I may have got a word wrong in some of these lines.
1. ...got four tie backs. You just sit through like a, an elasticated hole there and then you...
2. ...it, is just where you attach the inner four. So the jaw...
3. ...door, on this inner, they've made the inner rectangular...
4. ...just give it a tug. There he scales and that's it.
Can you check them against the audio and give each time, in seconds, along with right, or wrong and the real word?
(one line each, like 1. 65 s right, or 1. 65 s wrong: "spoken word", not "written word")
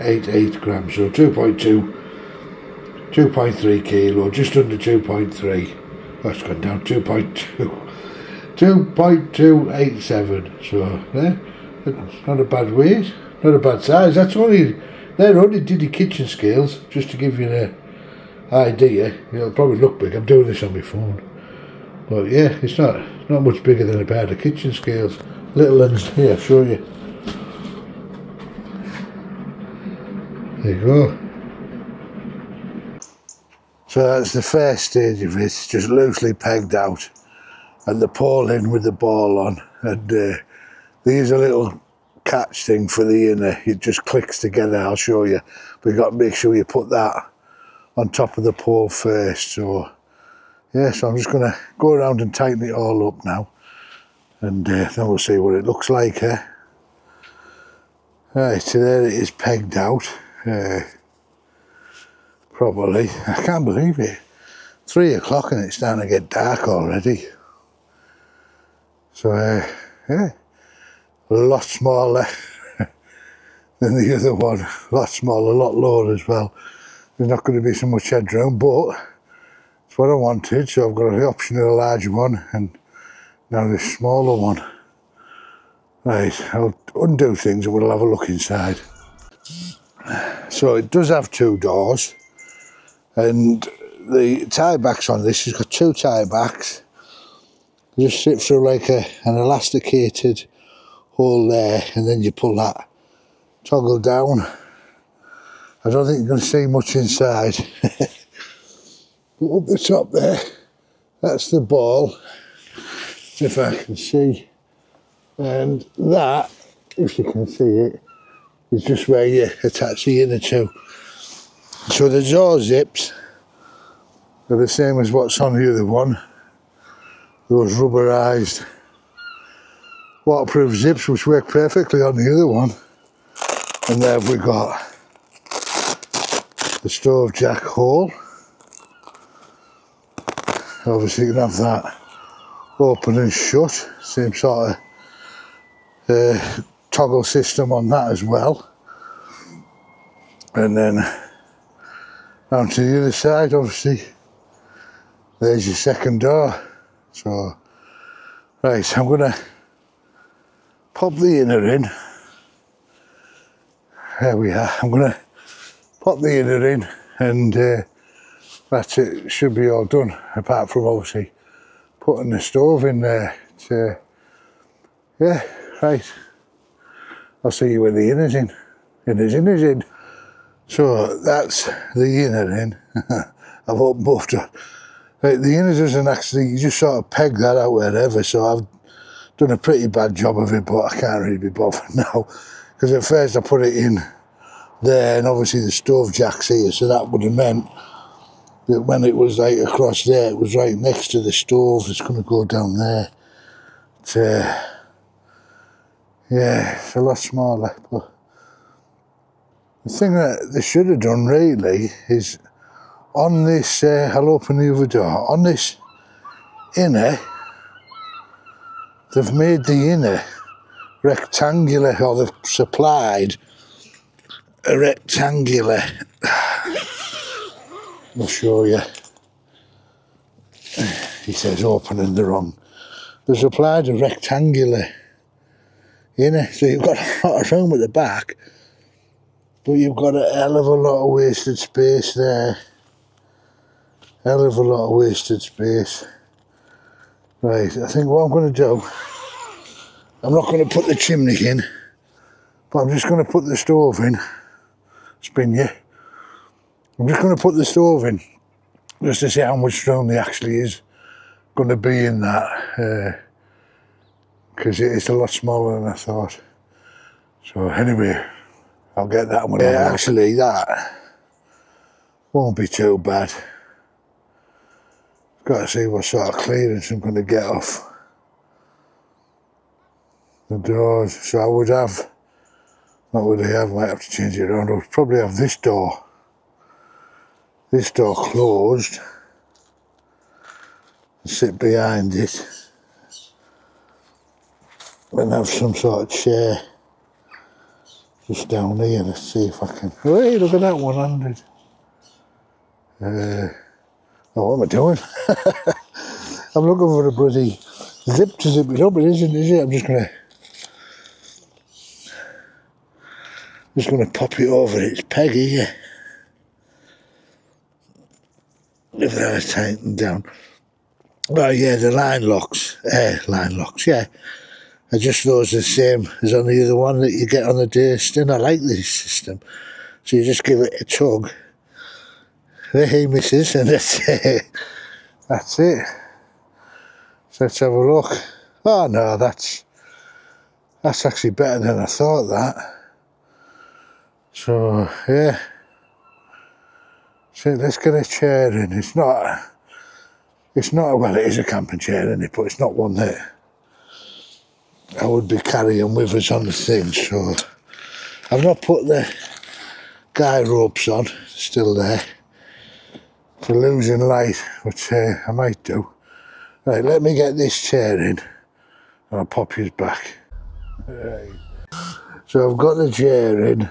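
1. 95 s wrong: "two", not "four"
2. 117 s wrong: "two", not "four"
3. 214 s right
4. 330 s wrong: "misses", not "scales".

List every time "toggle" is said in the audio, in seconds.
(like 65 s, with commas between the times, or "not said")
103 s, 146 s.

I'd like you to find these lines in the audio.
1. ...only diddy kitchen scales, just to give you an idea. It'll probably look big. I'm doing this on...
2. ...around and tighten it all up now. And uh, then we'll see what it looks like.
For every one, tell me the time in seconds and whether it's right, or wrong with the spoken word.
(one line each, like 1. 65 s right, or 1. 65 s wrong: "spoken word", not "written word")
1. 15 s right
2. 51 s right.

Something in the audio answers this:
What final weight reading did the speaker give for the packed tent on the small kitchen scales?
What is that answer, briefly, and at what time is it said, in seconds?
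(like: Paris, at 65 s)
2.287 kg, at 8 s.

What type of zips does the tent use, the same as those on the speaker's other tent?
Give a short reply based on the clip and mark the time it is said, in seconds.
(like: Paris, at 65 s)
rubberized waterproof zips, at 127 s.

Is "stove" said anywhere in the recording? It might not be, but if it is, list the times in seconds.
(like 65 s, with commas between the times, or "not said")
136 s, 172 s, 195 s, 201 s, 253 s, 257 s.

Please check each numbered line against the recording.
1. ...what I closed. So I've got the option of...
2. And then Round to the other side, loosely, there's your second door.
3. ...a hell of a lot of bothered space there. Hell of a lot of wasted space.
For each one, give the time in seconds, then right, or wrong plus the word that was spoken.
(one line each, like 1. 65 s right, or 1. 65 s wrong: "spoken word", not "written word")
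1. 79 s wrong: "wanted", not "closed"
2. 150 s wrong: "obviously", not "loosely"
3. 240 s wrong: "wasted", not "bothered".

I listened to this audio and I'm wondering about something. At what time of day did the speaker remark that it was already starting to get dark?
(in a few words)
3 o'clock.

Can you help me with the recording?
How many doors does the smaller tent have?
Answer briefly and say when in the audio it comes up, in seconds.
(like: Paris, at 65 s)
2, at 91 s.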